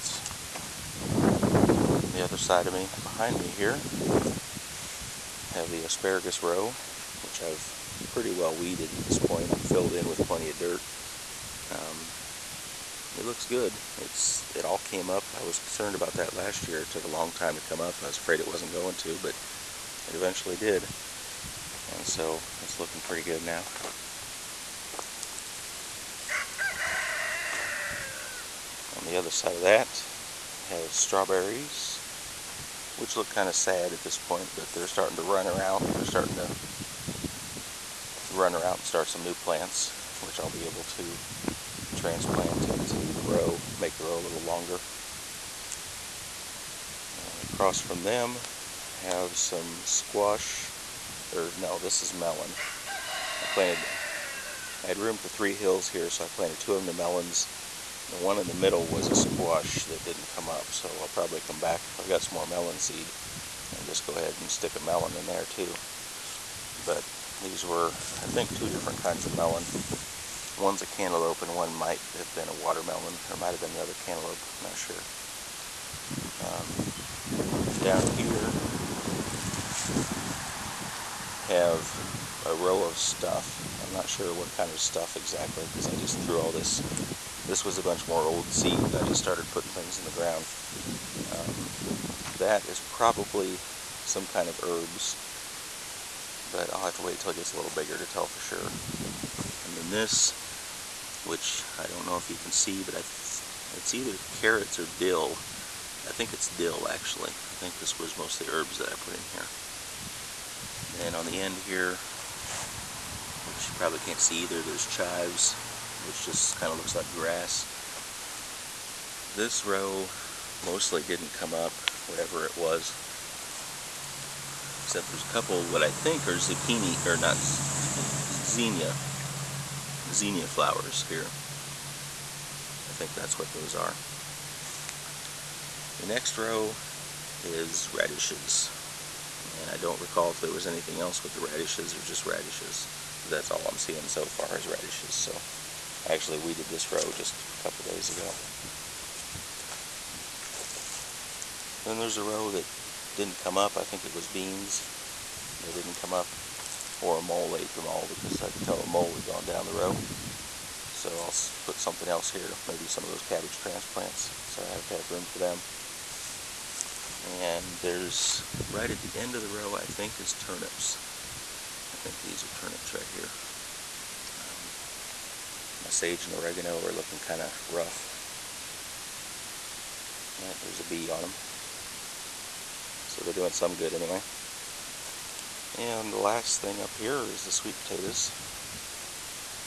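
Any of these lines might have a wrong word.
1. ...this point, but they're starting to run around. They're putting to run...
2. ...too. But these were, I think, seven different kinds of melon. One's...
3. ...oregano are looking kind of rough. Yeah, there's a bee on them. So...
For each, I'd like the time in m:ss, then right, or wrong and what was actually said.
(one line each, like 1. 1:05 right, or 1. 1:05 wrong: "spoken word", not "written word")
1. 0:34 wrong: "starting", not "putting"
2. 1:05 wrong: "two", not "seven"
3. 2:56 right.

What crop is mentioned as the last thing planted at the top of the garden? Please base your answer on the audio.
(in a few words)
Sweet potatoes.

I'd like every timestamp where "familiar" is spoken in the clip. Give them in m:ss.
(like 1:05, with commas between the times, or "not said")
not said.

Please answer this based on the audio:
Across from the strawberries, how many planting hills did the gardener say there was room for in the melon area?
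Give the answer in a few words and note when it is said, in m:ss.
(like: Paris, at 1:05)
3, at 0:55.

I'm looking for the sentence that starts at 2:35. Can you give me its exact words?
They didn't come up, or a mole ate them all because I could tell a mole had gone down the row.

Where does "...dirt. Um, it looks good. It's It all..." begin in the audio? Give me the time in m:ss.
0:10.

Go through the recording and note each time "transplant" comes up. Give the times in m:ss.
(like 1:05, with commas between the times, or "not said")
0:41, 2:43.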